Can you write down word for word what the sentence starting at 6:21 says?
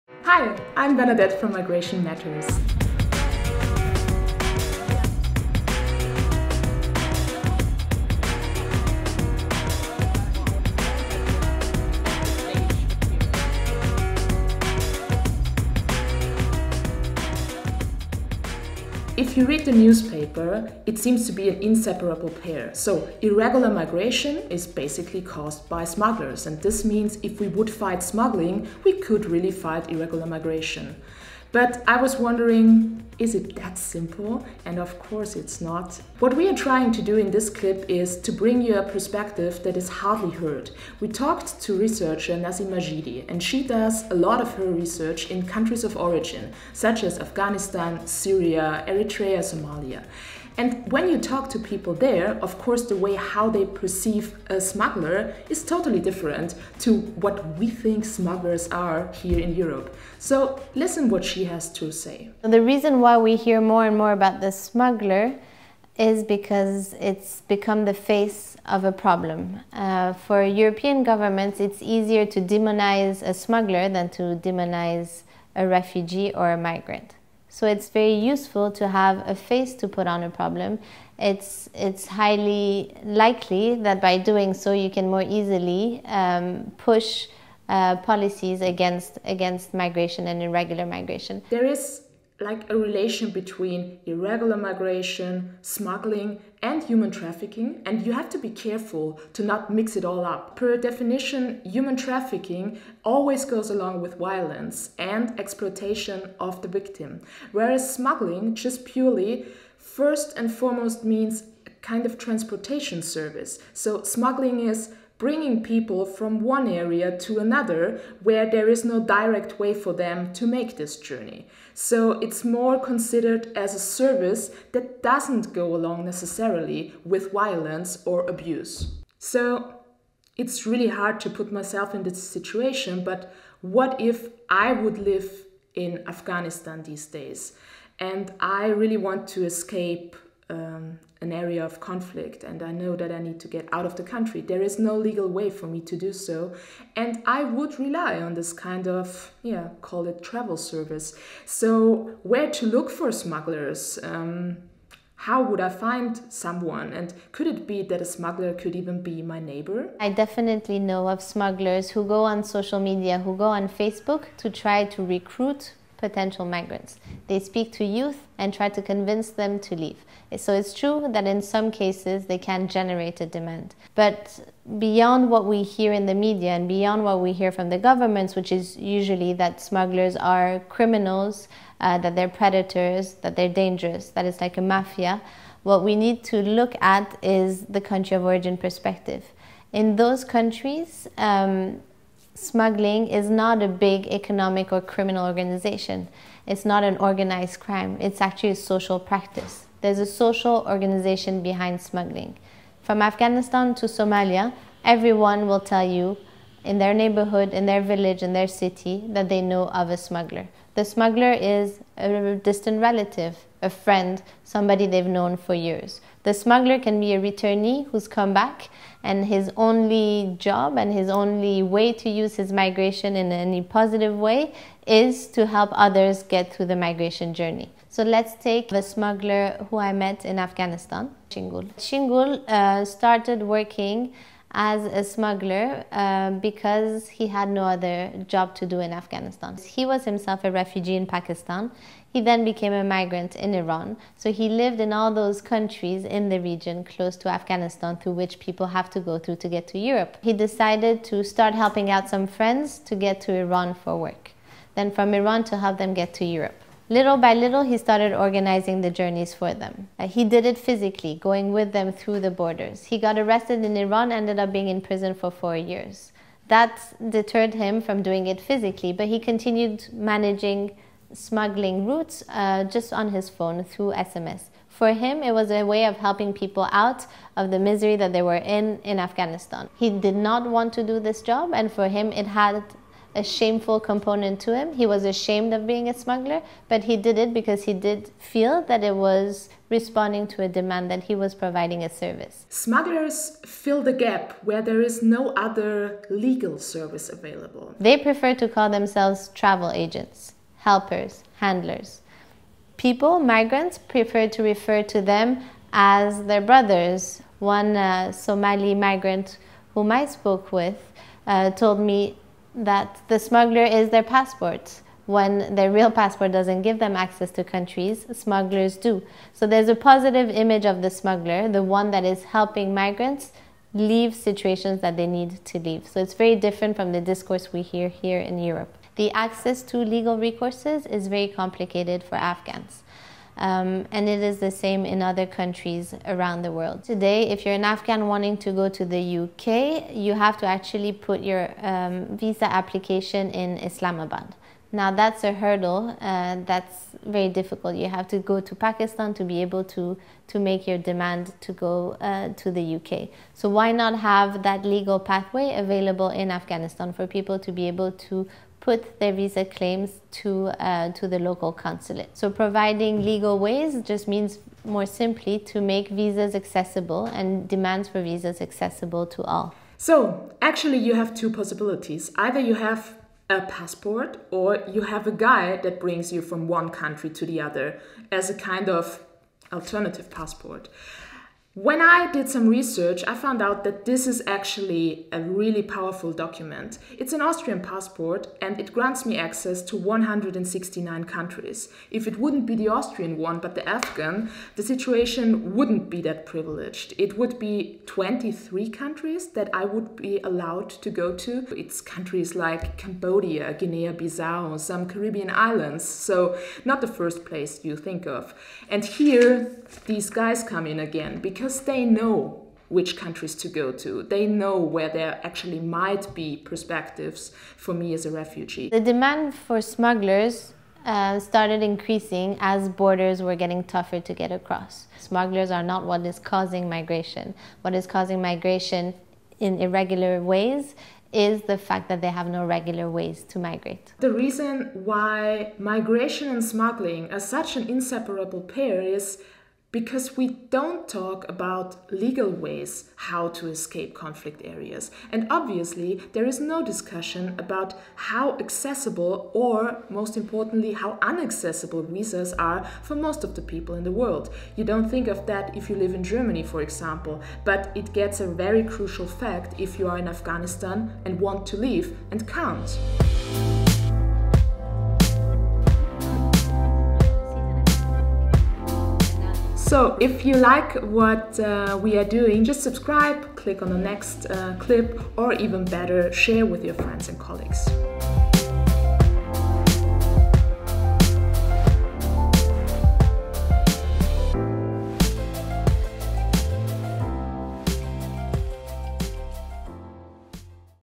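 When I did some research, I found out that this is actually a really powerful document.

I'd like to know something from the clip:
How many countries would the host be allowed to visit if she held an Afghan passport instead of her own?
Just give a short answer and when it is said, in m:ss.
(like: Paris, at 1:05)
23, at 6:37.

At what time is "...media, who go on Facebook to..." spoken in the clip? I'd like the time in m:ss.
2:42.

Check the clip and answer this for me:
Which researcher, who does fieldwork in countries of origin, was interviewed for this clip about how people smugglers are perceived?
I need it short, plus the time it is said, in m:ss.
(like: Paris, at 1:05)
Nassim Majidi, at 0:42.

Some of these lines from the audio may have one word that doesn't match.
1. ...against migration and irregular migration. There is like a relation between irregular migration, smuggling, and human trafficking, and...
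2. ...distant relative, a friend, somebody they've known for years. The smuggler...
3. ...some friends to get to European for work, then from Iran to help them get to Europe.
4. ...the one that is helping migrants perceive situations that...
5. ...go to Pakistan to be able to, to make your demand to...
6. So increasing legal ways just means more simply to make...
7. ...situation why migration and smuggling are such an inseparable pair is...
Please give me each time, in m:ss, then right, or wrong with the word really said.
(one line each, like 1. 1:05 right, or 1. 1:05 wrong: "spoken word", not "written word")
1. 1:29 right
2. 3:32 right
3. 4:12 wrong: "Iran", not "European"
4. 5:21 wrong: "leave", not "perceive"
5. 5:48 right
6. 6:02 wrong: "providing", not "increasing"
7. 7:14 wrong: "reason", not "situation".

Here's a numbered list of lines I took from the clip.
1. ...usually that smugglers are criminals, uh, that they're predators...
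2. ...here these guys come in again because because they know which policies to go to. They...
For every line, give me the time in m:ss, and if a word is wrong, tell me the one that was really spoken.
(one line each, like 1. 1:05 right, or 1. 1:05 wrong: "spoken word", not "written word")
1. 2:58 right
2. 6:48 wrong: "countries", not "policies".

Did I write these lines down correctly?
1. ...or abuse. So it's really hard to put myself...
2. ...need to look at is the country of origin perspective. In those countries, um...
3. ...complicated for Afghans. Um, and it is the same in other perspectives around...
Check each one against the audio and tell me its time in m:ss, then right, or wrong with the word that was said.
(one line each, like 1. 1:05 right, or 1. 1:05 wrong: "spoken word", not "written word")
1. 2:08 right
2. 3:05 right
3. 5:31 wrong: "countries", not "perspectives".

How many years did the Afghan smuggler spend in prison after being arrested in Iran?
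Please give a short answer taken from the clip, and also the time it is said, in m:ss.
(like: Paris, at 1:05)
4, at 4:25.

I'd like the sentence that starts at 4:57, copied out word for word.
They prefer to call themselves travel agents helpers, handlers.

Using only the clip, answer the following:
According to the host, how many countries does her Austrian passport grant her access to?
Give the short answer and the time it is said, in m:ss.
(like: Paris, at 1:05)
169, at 6:29.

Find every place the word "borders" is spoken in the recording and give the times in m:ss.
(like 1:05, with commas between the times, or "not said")
4:22, 7:02.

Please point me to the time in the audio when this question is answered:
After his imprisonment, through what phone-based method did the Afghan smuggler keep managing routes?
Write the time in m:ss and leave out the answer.
4:33.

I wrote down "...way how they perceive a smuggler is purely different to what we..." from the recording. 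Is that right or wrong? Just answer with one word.
wrong.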